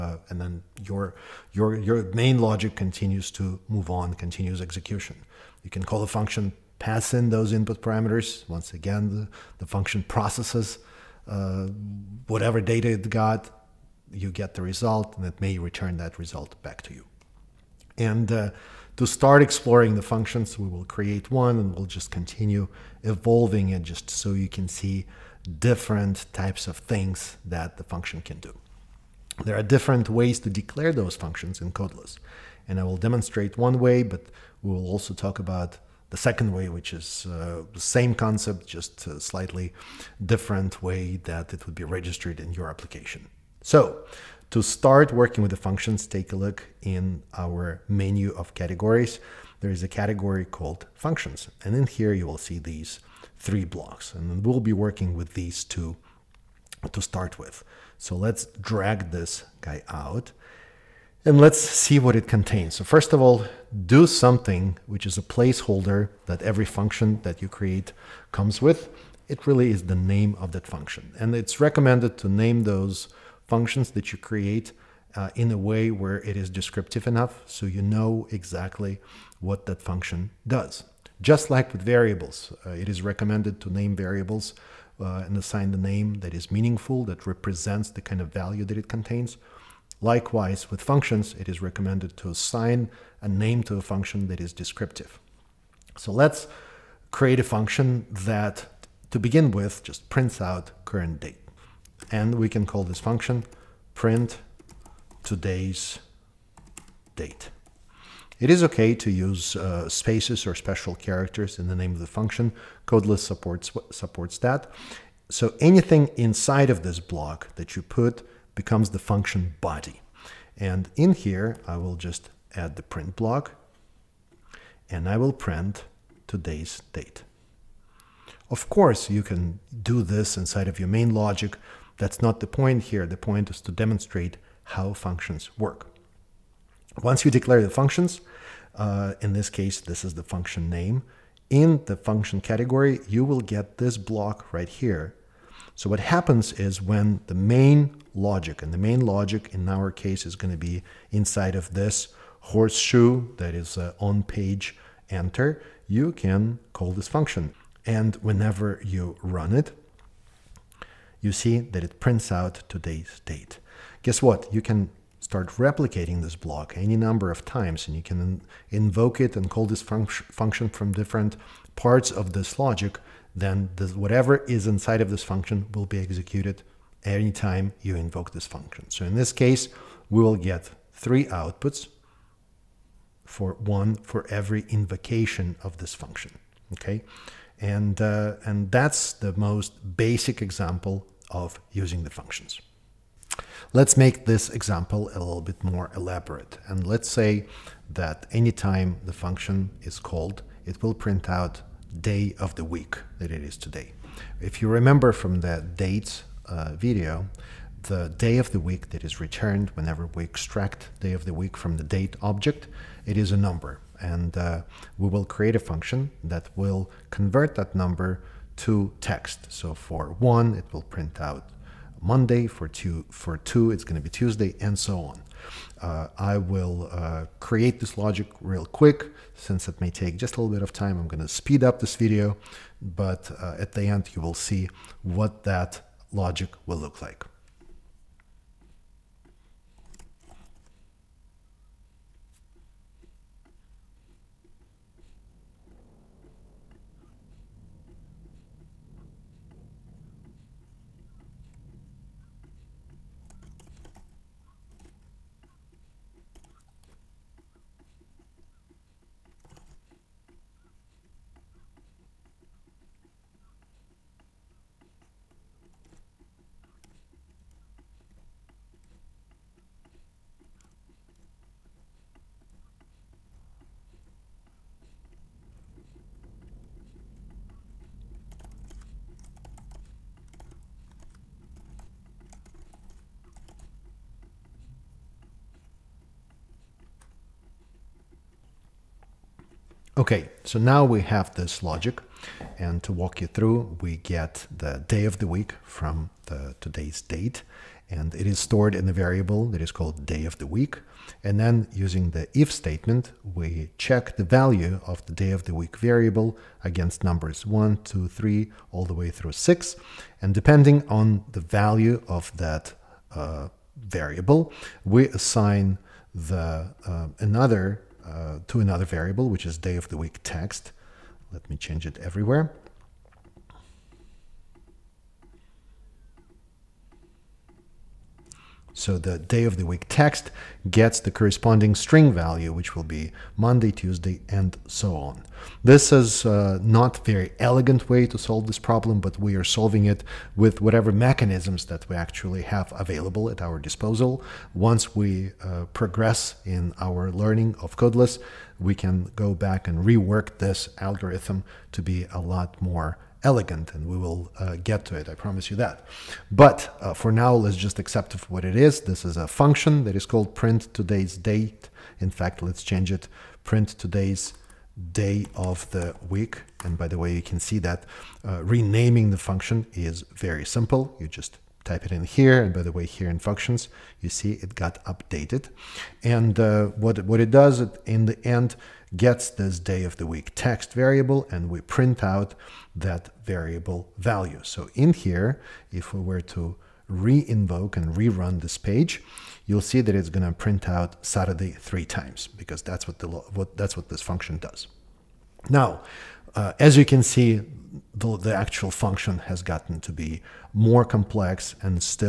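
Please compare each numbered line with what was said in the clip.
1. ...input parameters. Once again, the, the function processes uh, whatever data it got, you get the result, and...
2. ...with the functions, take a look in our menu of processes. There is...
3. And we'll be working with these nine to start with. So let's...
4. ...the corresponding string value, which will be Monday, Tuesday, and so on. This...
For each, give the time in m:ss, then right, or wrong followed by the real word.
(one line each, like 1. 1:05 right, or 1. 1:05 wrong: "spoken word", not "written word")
1. 0:07 right
2. 0:45 wrong: "categories", not "processes"
3. 0:54 wrong: "two", not "nine"
4. 5:30 right.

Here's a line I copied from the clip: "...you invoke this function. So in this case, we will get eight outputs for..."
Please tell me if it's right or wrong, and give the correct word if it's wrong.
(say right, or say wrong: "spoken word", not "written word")
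wrong: "three", not "eight".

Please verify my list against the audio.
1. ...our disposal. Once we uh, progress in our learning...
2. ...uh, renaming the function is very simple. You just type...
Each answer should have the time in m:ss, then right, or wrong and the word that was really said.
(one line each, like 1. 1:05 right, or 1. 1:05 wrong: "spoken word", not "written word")
1. 5:43 right
2. 6:08 right.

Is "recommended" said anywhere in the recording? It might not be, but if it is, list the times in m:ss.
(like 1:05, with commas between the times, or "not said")
1:11, 1:23, 1:31.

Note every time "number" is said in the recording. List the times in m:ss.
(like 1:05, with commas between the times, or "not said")
2:46, 3:33, 3:37, 5:07.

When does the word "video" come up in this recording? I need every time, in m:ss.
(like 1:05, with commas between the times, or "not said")
3:26, 3:51.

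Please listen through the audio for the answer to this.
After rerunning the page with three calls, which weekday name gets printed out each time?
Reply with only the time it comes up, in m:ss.
6:31.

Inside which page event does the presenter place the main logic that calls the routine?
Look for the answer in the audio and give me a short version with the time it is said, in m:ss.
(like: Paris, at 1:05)
on page enter, at 2:33.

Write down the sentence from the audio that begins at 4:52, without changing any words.
And to walk you through, we get the day of the week from the today's date.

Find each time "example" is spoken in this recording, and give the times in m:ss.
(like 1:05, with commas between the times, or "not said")
3:10, 3:14.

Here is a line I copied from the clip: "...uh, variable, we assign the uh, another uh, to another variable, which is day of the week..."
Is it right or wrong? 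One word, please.
right.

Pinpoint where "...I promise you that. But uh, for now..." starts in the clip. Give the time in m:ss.
5:55.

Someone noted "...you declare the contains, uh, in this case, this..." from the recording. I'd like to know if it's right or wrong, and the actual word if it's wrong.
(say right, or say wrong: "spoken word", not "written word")
wrong: "functions", not "contains".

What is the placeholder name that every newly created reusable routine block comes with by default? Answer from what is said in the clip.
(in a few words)
do something.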